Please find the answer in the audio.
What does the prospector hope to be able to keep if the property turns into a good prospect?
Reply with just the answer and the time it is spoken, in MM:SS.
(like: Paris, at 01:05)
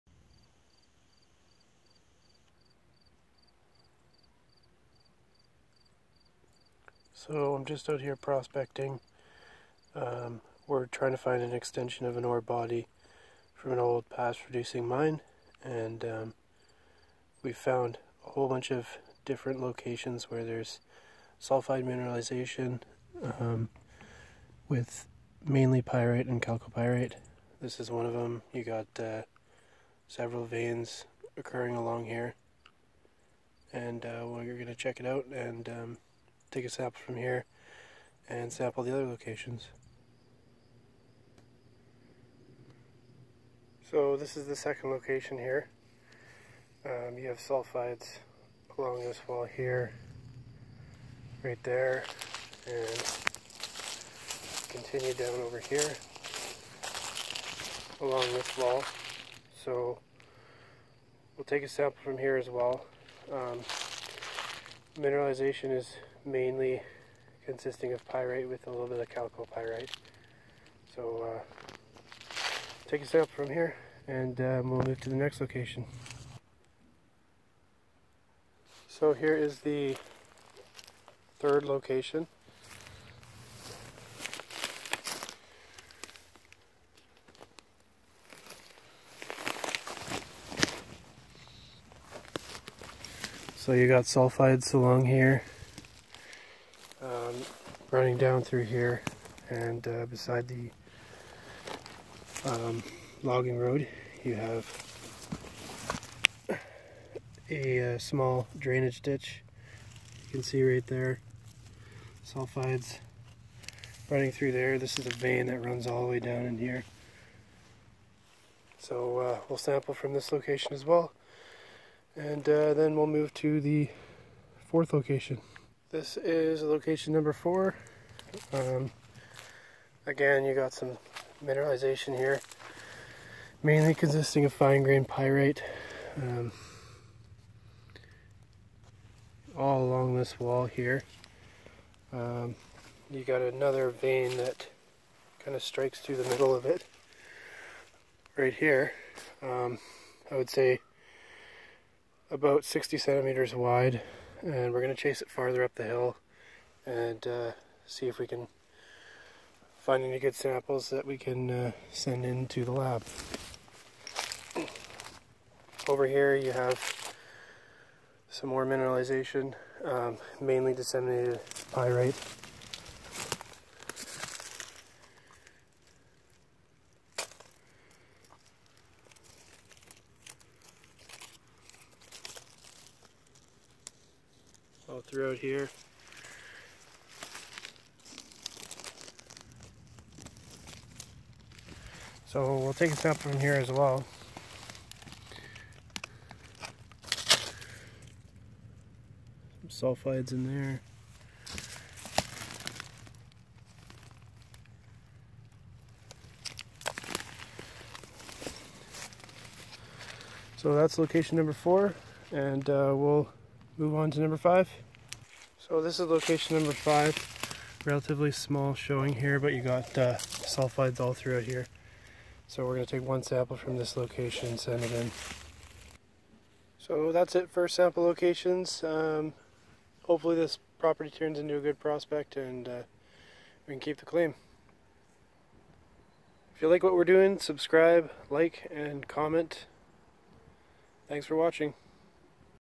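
The claim, at 03:53.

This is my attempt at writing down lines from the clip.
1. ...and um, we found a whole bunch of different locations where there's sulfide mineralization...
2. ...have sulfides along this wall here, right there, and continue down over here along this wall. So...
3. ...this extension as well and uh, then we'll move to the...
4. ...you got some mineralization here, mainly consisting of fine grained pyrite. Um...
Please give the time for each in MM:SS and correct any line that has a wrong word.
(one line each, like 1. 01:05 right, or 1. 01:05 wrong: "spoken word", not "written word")
1. 00:15 right
2. 00:47 right
3. 02:00 wrong: "location", not "extension"
4. 02:10 right.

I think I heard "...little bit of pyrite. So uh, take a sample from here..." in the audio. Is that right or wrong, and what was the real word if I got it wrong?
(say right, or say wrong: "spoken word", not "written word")
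right.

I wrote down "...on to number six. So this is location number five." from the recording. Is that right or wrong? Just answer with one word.
wrong.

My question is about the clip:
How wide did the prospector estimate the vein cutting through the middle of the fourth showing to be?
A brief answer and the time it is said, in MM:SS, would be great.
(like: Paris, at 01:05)
About 60 centimeters, at 02:32.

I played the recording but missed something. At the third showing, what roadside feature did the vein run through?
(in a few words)
Small drainage ditch.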